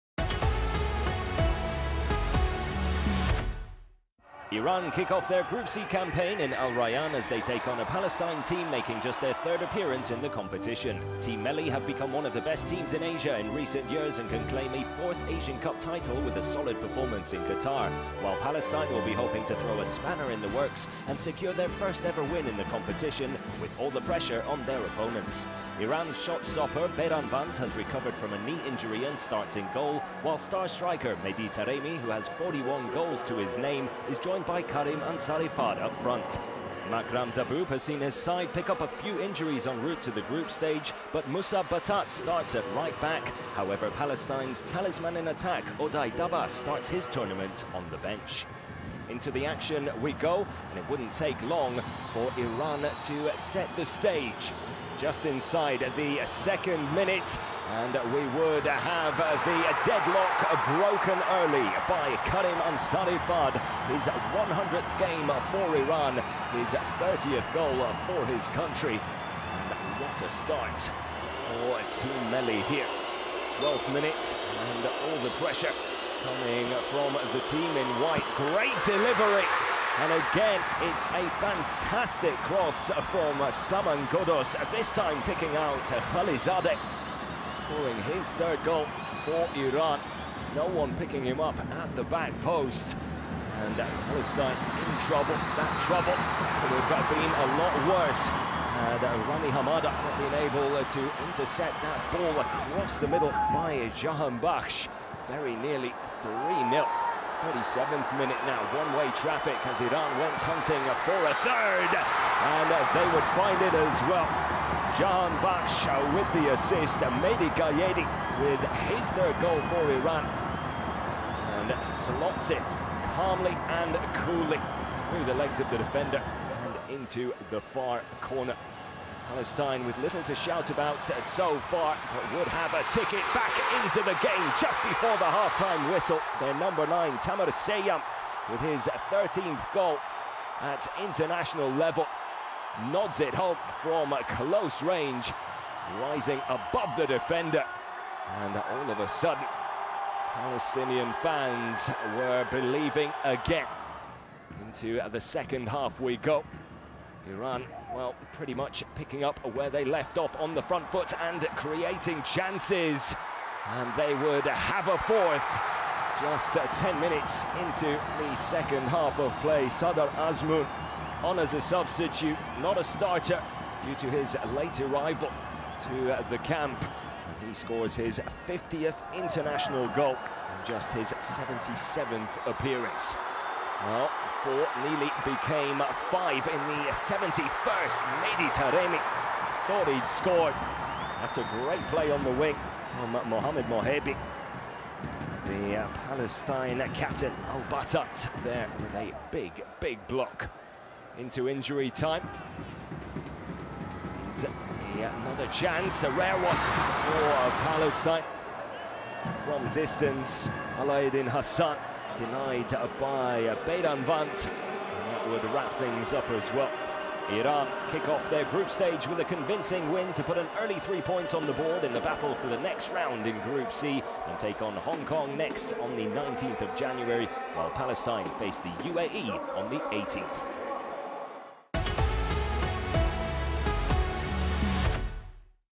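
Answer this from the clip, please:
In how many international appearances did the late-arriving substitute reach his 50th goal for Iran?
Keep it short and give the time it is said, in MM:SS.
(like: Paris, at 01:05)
77, at 03:01.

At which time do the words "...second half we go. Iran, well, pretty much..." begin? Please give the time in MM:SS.
02:35.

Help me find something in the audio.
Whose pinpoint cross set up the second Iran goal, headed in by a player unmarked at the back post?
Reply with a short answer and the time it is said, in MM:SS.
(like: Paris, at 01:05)
Saman Ghoddos, at 01:23.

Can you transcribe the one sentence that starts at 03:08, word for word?
Mehdi Taremi thought he'd scored after great play on the wing from Mohamed Mohebi.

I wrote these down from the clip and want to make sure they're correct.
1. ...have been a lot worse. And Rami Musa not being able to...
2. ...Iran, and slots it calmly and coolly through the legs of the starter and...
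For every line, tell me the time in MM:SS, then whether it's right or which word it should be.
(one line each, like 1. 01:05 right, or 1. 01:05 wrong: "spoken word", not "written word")
1. 01:36 wrong: "Hamada", not "Musa"
2. 01:59 wrong: "defender", not "starter".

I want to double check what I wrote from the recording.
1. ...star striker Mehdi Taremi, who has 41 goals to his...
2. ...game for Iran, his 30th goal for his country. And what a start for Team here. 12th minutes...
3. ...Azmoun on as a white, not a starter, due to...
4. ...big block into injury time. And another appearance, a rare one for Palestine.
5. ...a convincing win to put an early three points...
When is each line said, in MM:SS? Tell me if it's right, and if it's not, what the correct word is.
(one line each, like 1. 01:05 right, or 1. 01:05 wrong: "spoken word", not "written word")
1. 00:30 right
2. 01:04 right
3. 02:50 wrong: "substitute", not "white"
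4. 03:19 wrong: "chance", not "appearance"
5. 03:39 right.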